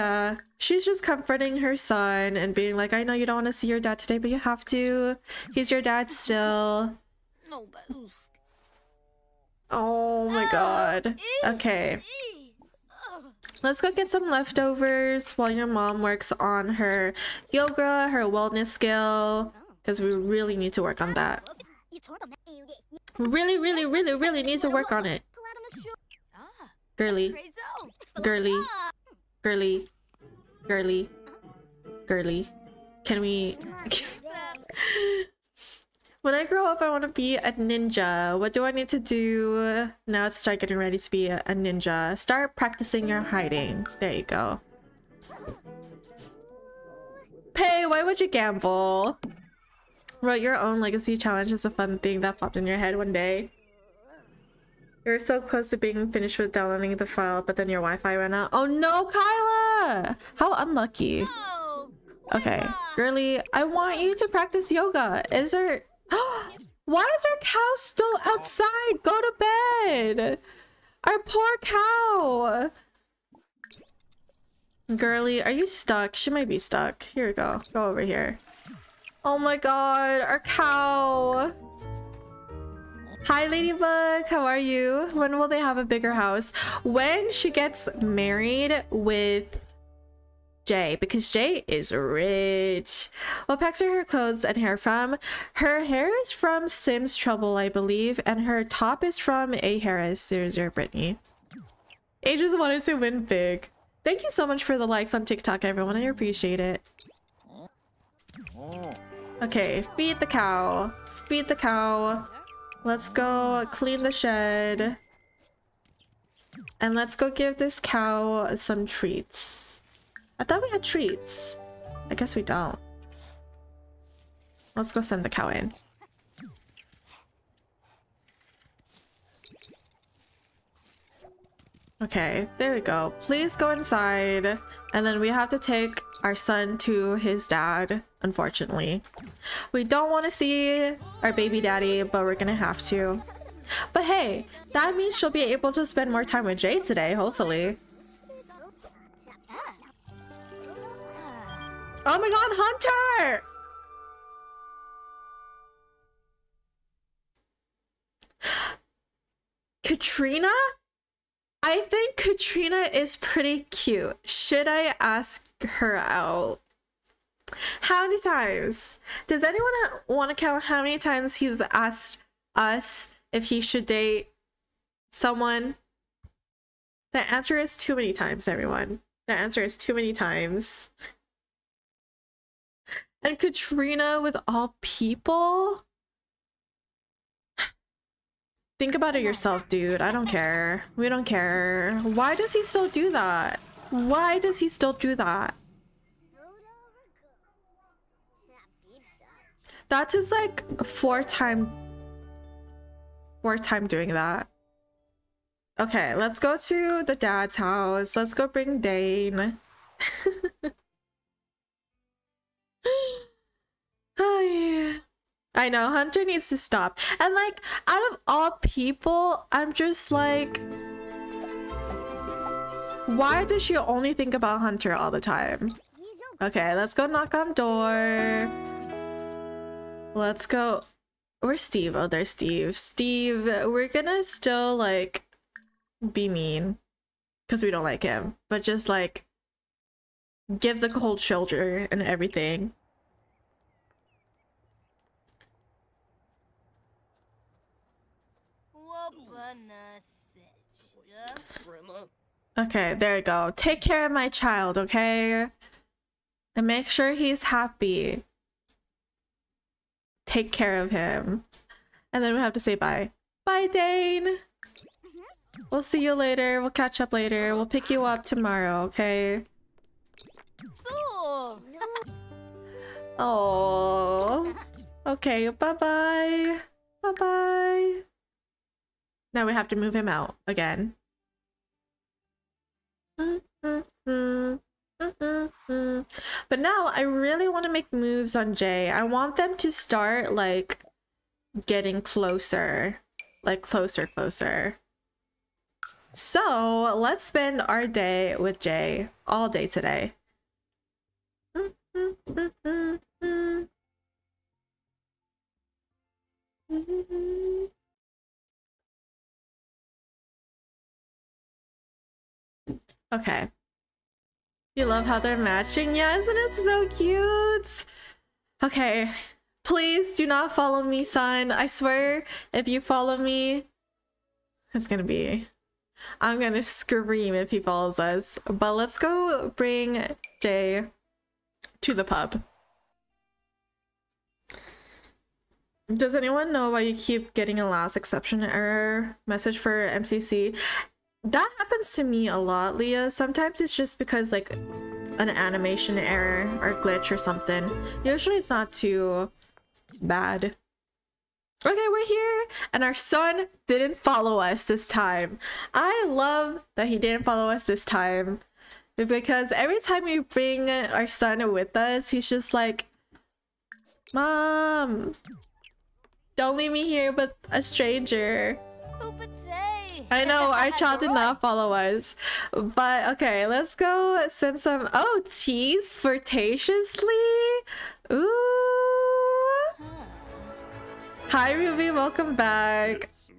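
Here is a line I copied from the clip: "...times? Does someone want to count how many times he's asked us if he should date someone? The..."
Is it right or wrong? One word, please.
wrong.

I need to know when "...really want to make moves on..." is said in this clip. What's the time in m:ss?
4:47.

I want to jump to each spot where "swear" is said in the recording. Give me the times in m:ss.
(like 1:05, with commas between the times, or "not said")
5:21.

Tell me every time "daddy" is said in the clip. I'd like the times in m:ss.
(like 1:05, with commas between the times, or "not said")
2:21.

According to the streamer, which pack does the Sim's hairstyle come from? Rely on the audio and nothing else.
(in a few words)
Sims Trouble.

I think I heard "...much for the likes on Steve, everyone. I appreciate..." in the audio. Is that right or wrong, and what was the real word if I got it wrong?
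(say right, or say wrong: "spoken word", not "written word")
wrong: "TikTok", not "Steve".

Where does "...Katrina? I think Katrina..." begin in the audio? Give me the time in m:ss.
2:39.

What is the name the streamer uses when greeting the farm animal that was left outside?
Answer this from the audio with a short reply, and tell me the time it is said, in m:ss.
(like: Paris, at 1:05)
Ladybug, at 1:23.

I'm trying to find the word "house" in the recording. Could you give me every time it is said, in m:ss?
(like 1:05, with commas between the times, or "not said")
1:26, 3:27.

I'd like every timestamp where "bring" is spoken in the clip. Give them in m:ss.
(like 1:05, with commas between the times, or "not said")
3:28, 5:29, 6:00.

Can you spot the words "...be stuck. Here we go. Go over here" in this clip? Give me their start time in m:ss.
1:16.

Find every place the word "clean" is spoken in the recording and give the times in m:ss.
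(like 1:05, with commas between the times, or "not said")
1:53.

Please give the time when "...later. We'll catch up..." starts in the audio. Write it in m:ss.
4:26.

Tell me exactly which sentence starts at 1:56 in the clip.
And let's go give this cow some treats.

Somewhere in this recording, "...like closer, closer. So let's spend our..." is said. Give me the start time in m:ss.
4:53.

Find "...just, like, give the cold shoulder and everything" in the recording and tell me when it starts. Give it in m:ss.
3:58.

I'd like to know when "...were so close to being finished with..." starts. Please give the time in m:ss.
0:55.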